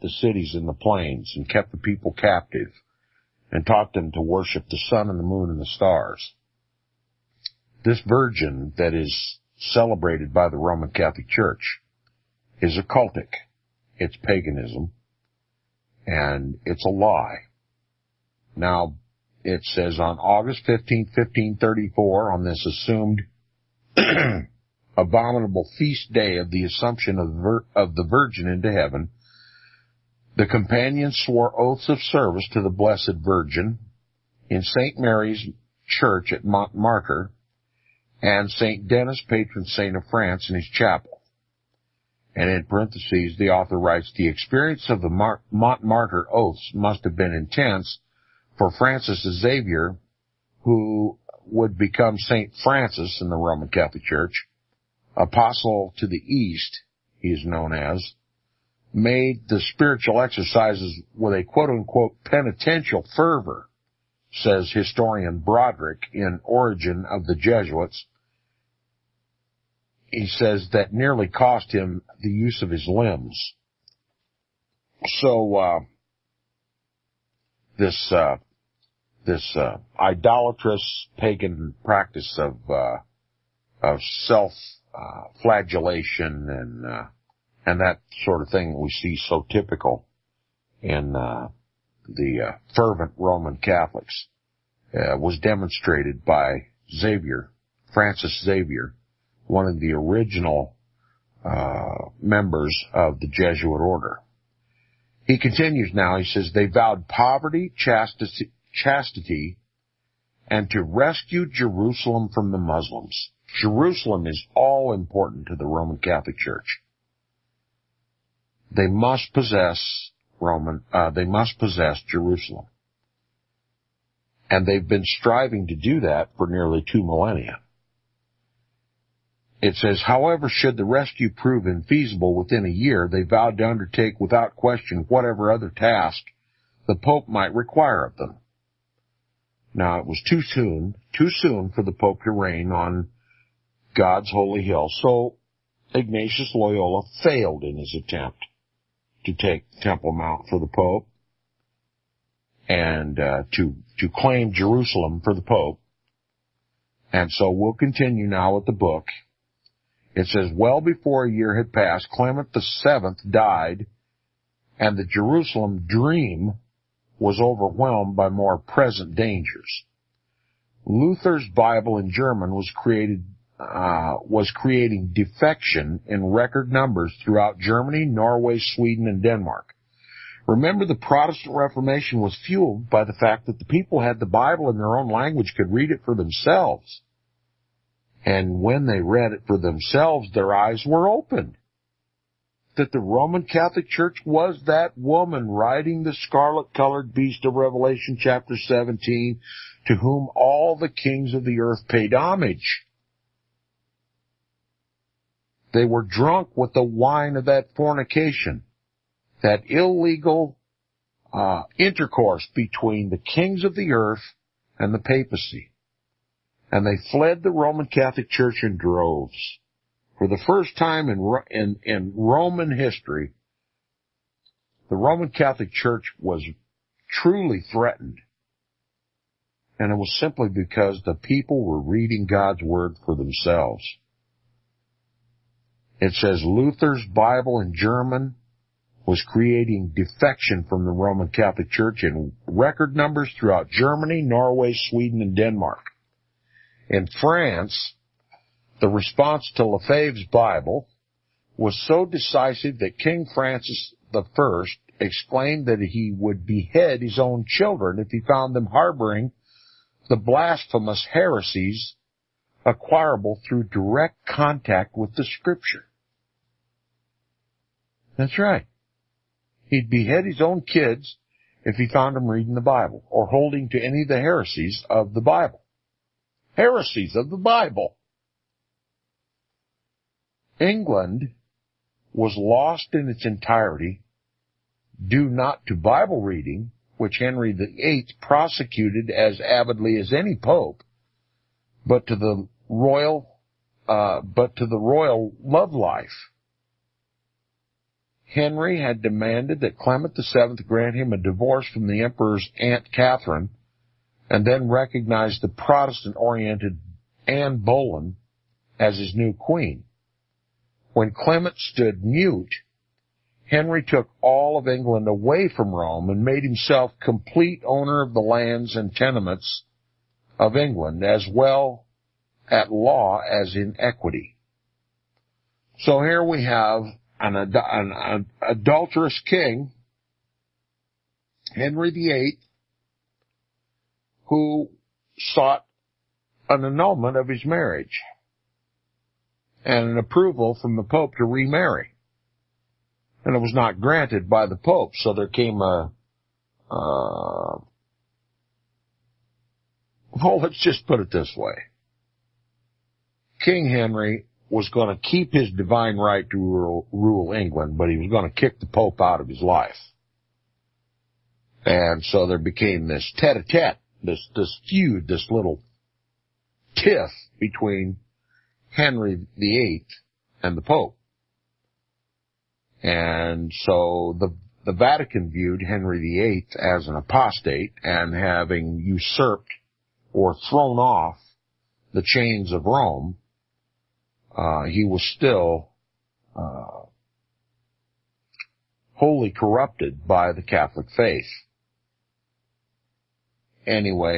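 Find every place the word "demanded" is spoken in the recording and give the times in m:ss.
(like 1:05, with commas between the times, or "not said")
4:59.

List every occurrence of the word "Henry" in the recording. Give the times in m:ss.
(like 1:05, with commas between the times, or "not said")
4:47, 4:58, 5:13, 5:31, 5:53, 6:08, 6:15.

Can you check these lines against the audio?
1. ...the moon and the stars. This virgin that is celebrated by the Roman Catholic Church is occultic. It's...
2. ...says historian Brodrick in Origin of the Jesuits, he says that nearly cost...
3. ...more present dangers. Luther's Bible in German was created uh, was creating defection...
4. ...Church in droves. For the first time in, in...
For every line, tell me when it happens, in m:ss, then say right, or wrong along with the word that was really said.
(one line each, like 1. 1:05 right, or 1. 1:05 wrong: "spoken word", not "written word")
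1. 0:05 right
2. 1:04 right
3. 2:48 right
4. 3:38 right.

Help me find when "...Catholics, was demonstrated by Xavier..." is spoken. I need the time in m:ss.
1:33.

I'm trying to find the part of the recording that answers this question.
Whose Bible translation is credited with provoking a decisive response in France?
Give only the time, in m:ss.
4:09.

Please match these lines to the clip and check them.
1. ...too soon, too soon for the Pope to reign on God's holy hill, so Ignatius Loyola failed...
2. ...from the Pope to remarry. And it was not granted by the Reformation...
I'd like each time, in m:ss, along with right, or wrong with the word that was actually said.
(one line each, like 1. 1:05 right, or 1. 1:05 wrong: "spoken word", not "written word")
1. 2:20 right
2. 5:40 wrong: "Pope", not "Reformation".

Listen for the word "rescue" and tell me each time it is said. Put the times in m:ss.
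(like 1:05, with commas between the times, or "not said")
1:50, 2:10.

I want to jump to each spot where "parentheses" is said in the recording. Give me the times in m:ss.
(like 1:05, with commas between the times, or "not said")
0:42.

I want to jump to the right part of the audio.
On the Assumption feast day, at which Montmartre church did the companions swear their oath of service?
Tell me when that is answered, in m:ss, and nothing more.
0:34.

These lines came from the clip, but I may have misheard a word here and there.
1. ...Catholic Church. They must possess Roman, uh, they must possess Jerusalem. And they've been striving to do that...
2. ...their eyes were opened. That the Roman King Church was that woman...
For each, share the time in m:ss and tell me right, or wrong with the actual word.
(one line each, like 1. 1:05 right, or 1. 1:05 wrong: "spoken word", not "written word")
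1. 1:55 right
2. 3:10 wrong: "Catholic", not "King".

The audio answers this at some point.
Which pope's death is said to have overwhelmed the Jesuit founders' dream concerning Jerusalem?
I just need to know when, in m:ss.
2:42.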